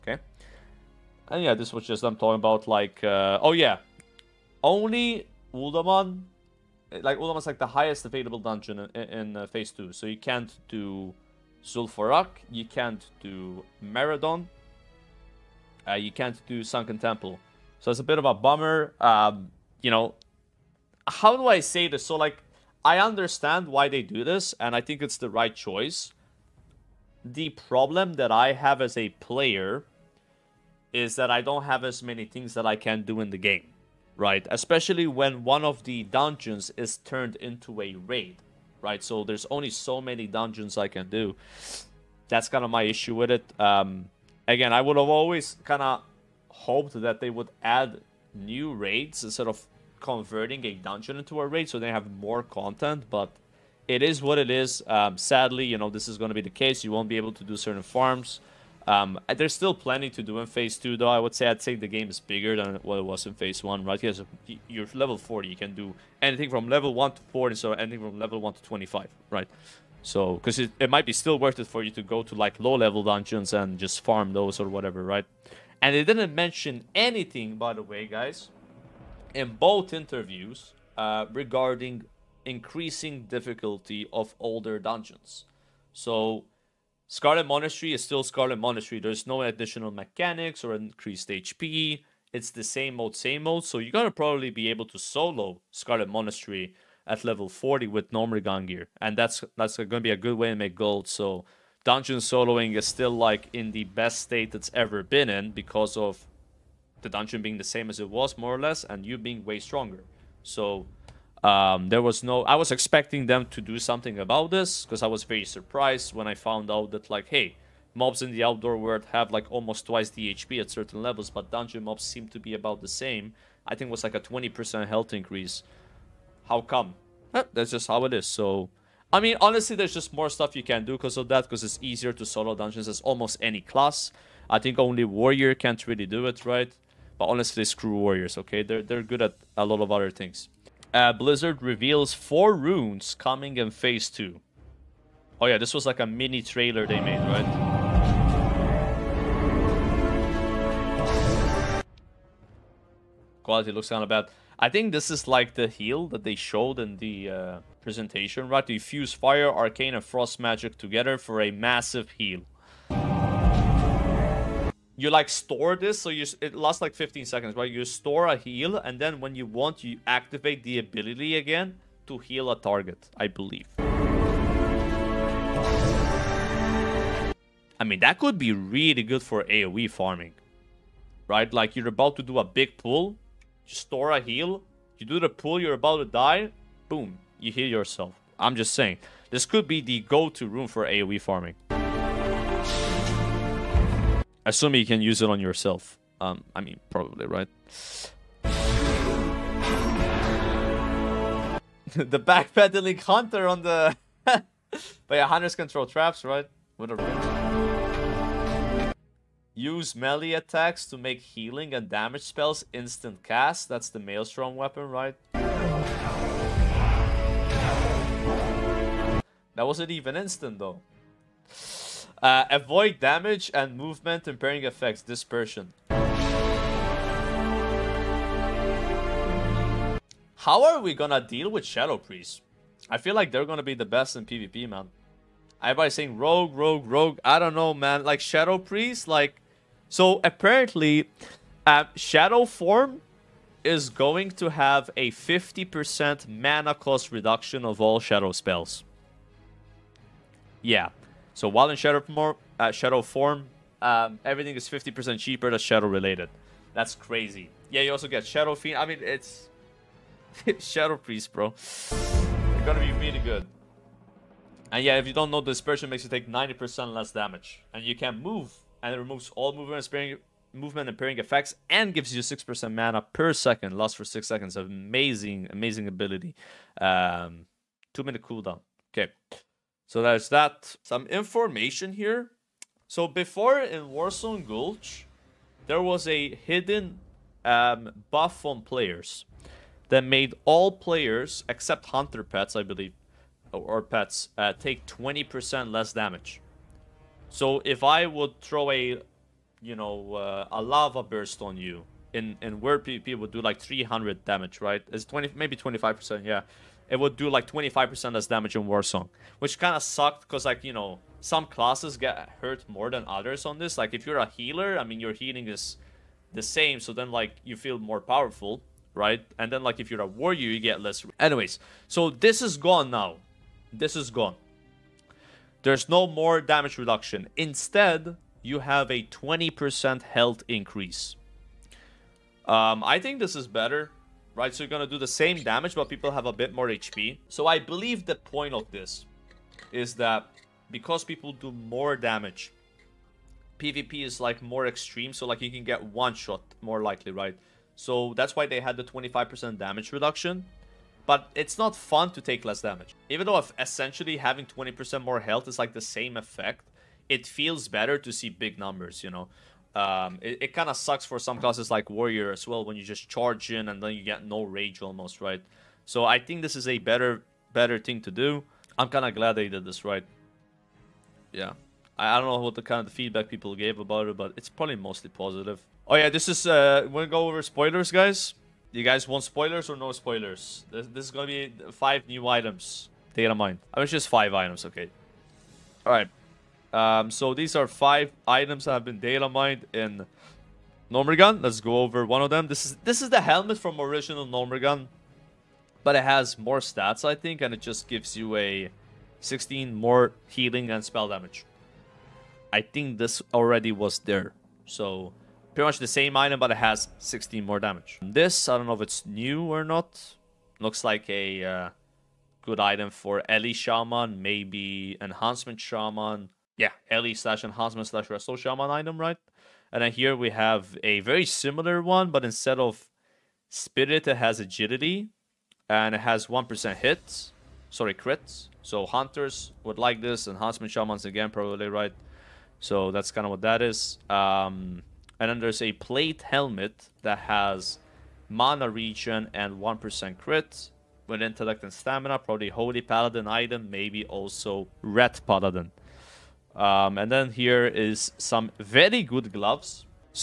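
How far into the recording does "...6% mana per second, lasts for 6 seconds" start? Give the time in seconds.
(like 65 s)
272 s.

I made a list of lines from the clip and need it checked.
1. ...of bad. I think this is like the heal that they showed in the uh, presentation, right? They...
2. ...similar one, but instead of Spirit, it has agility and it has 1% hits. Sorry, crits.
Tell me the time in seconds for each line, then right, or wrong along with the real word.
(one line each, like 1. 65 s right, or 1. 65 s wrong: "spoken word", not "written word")
1. 154 s right
2. 421 s right.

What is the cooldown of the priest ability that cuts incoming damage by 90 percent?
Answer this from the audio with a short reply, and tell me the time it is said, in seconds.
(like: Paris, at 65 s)
2 minutes, at 277 s.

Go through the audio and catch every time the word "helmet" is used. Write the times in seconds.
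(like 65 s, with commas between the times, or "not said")
393 s, 436 s.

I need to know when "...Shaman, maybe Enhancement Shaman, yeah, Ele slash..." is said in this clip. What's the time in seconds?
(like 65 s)
413 s.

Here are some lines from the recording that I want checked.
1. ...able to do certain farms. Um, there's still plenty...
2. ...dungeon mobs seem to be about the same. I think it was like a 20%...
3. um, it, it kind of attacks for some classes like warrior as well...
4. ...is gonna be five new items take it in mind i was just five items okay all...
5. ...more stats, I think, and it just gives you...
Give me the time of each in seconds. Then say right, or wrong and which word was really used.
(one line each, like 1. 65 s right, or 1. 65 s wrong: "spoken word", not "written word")
1. 57 s right
2. 121 s right
3. 359 s wrong: "sucks", not "attacks"
4. 381 s right
5. 396 s right.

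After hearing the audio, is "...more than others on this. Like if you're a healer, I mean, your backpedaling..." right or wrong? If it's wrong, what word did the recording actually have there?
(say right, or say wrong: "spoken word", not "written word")
wrong: "healing", not "backpedaling".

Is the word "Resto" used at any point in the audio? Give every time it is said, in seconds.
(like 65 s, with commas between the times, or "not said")
418 s.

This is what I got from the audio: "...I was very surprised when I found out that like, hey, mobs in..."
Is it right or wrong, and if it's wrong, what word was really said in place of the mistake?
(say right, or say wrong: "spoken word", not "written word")
right.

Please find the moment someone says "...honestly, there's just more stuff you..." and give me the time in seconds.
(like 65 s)
129 s.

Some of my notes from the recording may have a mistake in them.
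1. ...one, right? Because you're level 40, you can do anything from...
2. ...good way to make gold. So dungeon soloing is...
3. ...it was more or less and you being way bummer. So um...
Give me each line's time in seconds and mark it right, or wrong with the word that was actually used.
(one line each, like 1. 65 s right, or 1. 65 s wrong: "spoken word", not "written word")
1. 63 s right
2. 100 s right
3. 107 s wrong: "stronger", not "bummer".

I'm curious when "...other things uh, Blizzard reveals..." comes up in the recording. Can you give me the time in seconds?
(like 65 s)
139 s.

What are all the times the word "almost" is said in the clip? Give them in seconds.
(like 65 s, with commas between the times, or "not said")
119 s, 132 s, 364 s.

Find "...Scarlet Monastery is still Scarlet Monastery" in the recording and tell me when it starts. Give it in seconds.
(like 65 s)
87 s.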